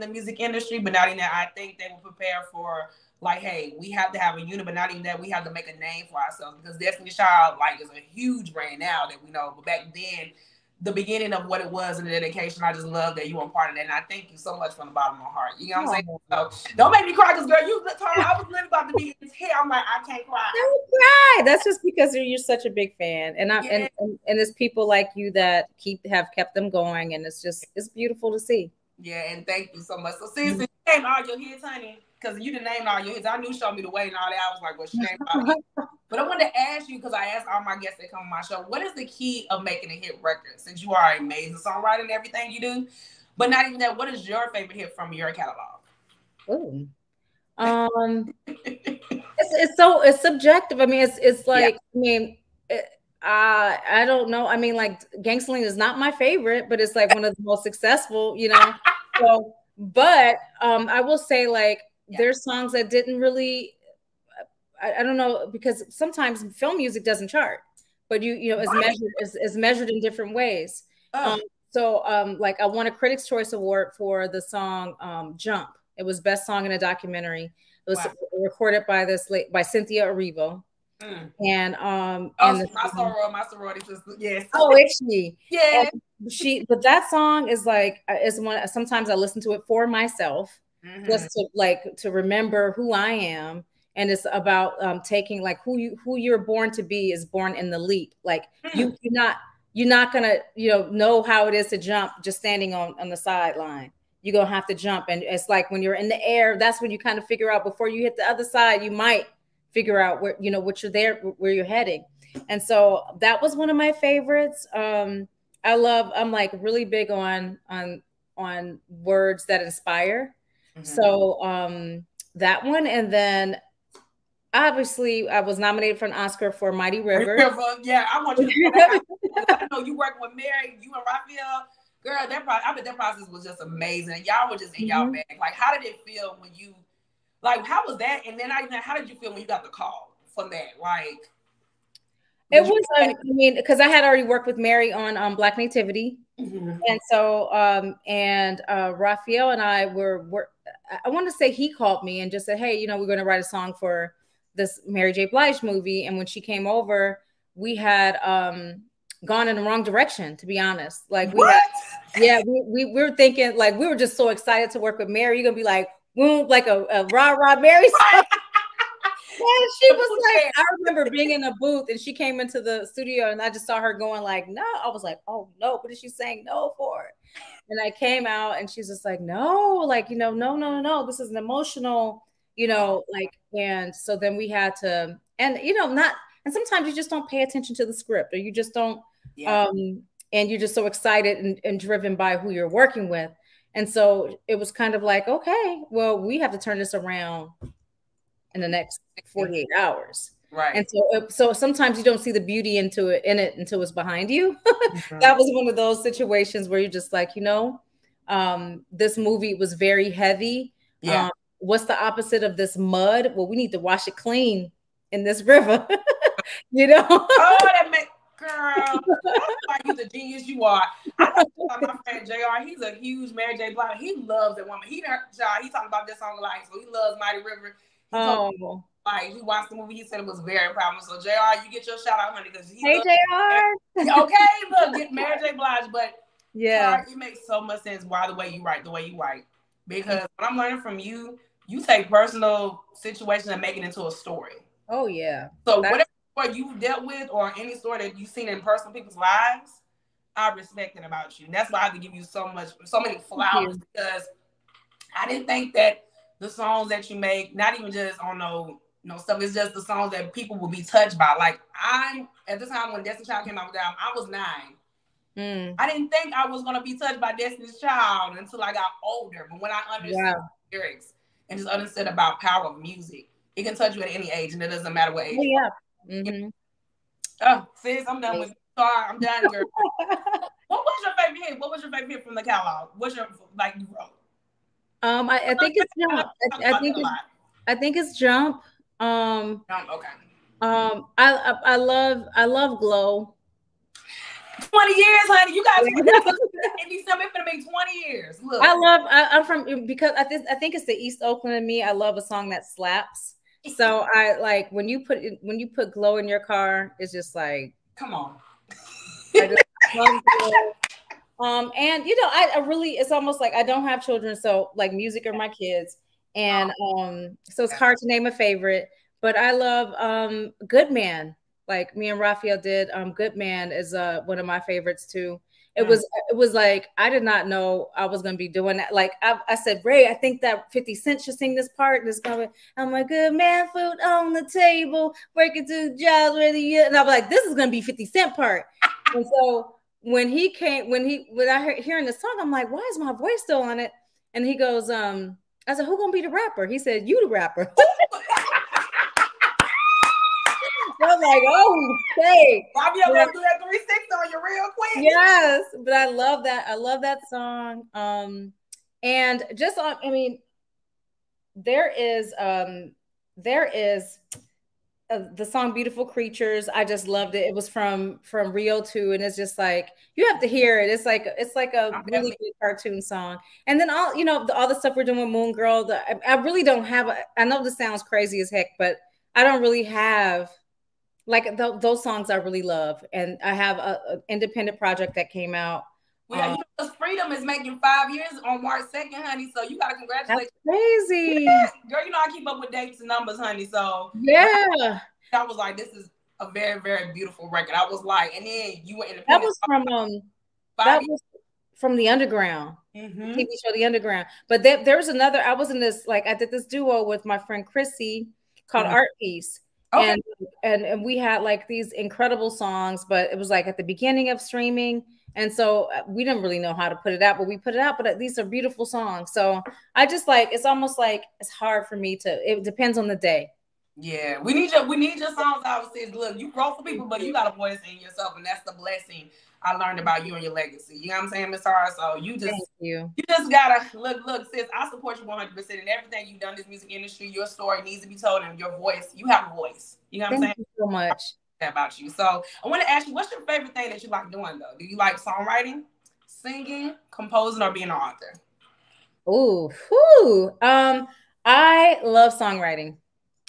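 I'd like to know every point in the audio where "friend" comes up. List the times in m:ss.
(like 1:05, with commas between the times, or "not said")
3:42, 6:47.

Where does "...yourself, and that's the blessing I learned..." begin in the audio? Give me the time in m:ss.
7:07.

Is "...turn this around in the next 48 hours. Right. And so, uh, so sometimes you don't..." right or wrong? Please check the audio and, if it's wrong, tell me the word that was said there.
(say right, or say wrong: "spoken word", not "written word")
right.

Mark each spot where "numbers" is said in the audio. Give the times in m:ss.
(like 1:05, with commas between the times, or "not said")
6:33.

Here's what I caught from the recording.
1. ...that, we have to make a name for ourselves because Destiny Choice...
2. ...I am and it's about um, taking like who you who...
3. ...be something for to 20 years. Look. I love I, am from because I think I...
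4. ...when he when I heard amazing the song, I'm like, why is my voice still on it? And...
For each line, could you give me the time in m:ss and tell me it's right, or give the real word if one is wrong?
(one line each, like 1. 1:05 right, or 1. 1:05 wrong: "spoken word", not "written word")
1. 0:05 wrong: "Child", not "Choice"
2. 1:32 right
3. 4:56 right
4. 5:40 wrong: "hearing", not "amazing".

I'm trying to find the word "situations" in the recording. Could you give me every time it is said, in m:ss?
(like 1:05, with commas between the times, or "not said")
3:26, 4:02.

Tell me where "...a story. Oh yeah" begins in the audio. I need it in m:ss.
4:04.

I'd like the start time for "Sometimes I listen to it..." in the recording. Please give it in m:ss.
1:28.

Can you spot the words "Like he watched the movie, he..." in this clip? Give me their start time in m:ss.
3:49.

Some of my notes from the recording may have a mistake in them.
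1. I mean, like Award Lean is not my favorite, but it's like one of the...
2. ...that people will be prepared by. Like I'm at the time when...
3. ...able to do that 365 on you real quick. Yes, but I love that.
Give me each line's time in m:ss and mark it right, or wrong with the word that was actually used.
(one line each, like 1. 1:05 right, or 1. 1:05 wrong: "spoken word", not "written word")
1. 0:54 wrong: "Gangsta", not "Award"
2. 4:20 wrong: "touched", not "prepared"
3. 5:53 wrong: "360", not "365".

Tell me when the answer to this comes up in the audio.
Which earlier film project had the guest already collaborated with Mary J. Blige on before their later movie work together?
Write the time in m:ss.
2:25.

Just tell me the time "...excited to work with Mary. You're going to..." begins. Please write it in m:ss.
2:44.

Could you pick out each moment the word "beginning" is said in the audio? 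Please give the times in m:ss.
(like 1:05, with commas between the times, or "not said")
0:10, 6:53.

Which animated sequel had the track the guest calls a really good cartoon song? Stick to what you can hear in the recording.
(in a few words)
Rio 2.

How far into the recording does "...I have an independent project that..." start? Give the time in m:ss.
6:23.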